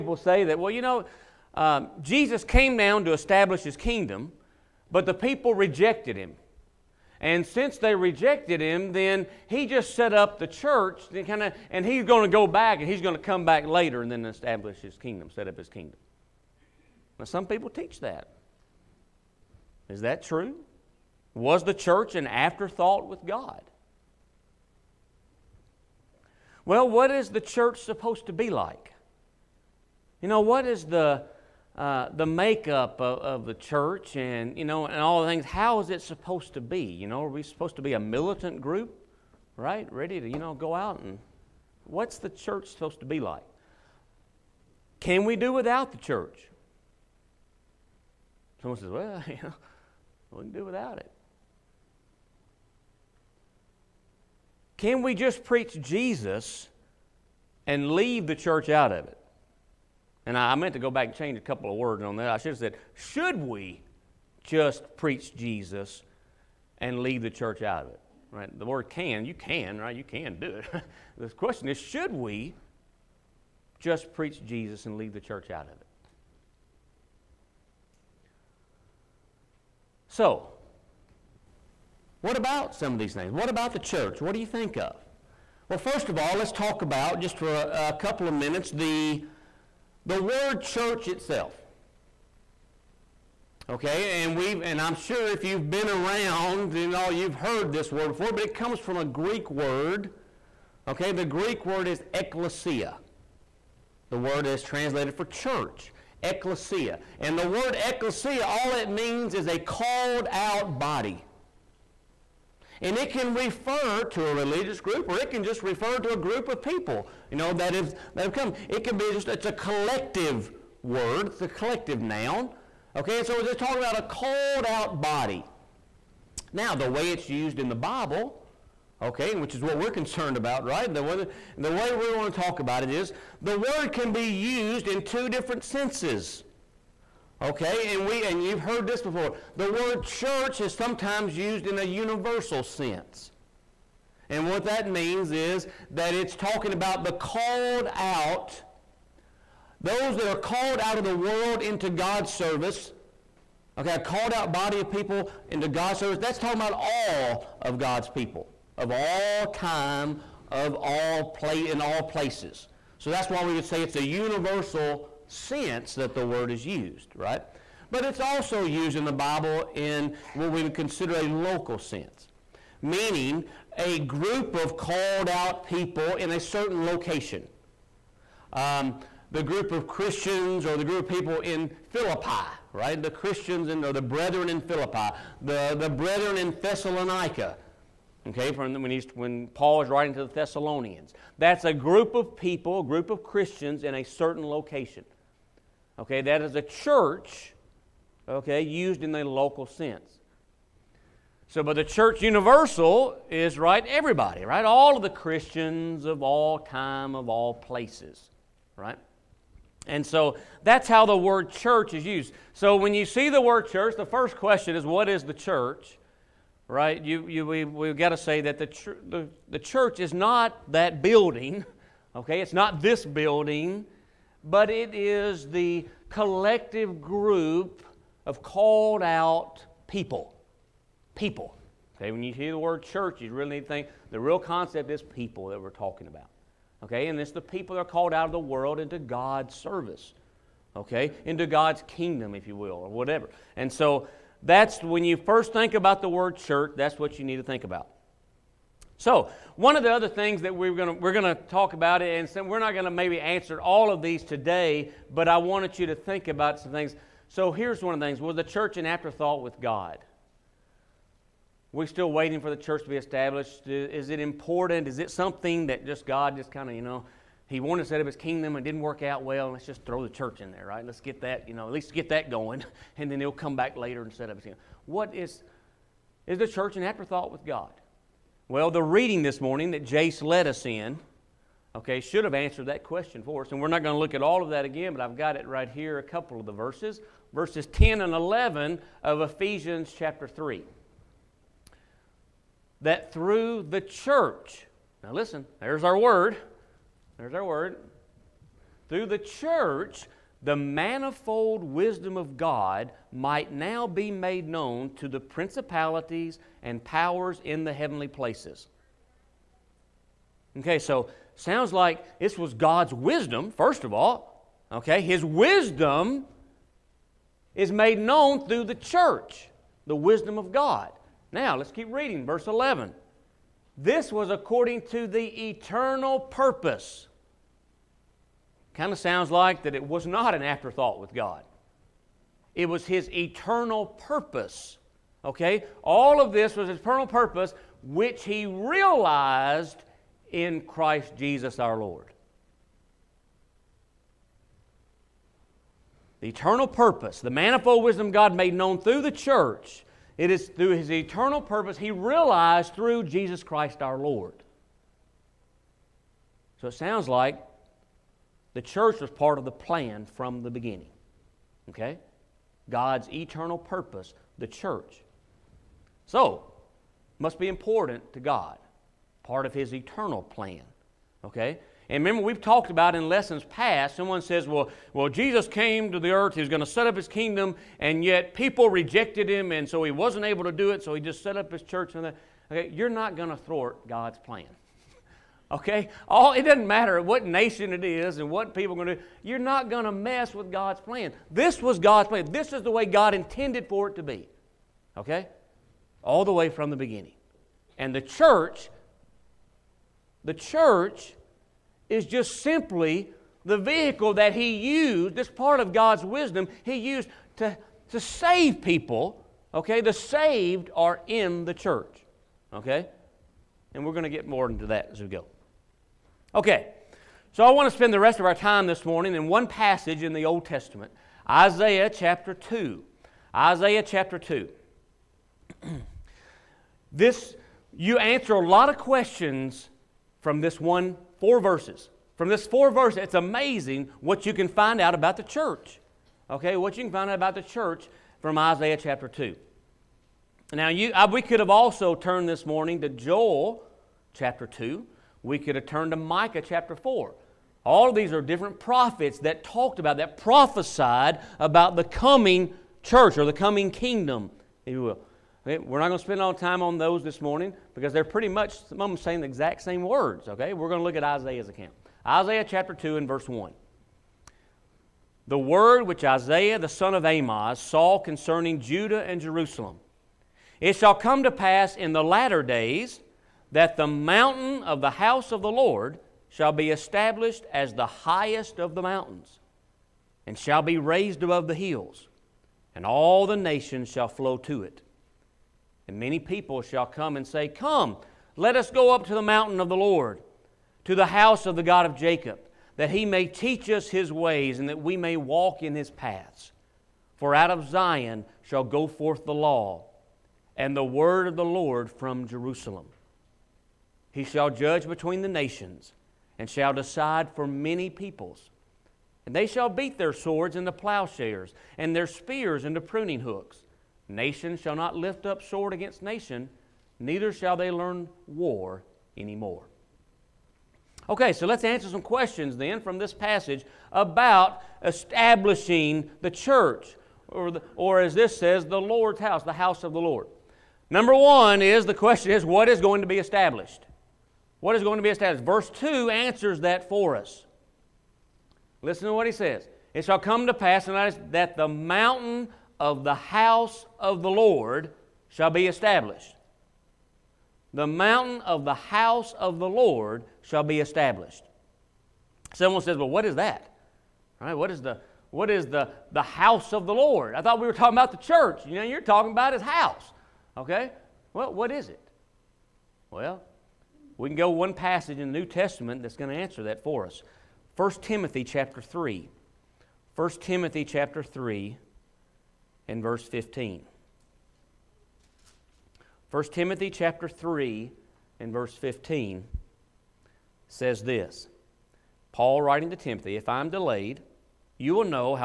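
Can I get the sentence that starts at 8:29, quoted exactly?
And they shall beat their swords into plowshares and their spears into pruning hooks.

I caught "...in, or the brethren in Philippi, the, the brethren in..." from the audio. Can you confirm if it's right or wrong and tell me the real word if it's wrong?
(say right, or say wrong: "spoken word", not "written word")
right.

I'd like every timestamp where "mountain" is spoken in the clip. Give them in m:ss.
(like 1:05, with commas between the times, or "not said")
7:53, 7:58, 8:09, 9:01, 9:07.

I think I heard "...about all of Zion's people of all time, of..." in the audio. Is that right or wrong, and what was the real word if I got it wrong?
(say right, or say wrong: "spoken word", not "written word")
wrong: "God", not "Zion".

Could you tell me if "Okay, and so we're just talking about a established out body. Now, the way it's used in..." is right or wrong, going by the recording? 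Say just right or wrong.
wrong.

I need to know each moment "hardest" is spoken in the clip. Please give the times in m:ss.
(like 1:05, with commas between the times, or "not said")
not said.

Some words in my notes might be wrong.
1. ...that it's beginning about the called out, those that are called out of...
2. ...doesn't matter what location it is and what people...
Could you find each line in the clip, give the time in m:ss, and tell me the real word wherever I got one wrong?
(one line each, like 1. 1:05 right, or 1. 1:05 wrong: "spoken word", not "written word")
1. 2:25 wrong: "talking", not "beginning"
2. 6:26 wrong: "nation", not "location".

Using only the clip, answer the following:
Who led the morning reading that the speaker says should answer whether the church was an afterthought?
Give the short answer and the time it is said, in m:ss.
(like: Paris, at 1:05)
Jace, at 4:39.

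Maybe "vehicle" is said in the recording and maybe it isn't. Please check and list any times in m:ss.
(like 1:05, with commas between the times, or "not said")
6:43.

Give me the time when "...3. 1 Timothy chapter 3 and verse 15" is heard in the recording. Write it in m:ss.
9:28.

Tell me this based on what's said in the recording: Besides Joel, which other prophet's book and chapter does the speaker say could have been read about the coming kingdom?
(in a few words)
Micah 4.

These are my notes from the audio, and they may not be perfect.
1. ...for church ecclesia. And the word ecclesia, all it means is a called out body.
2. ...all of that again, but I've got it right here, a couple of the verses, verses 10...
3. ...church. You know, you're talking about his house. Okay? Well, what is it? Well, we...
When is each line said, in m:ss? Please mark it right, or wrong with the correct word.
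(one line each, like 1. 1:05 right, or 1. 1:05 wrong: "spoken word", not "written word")
1. 1:45 right
2. 4:44 right
3. 9:18 right.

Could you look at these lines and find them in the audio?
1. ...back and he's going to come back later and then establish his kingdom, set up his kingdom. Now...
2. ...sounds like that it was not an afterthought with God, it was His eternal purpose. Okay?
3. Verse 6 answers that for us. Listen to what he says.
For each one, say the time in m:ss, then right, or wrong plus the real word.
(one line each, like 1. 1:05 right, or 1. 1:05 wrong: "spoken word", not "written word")
1. 0:12 right
2. 5:28 right
3. 8:55 wrong: "2", not "6".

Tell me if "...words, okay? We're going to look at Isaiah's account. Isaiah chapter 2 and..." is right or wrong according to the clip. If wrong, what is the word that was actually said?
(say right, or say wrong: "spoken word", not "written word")
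right.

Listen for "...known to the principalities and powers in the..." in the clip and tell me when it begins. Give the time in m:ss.
5:04.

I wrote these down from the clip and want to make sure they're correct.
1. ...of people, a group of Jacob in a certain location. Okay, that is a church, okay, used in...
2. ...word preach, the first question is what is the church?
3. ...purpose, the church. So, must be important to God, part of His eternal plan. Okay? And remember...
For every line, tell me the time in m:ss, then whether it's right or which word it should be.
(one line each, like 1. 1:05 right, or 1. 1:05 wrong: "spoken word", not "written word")
1. 3:12 wrong: "Christians", not "Jacob"
2. 3:33 wrong: "church", not "preach"
3. 6:03 right.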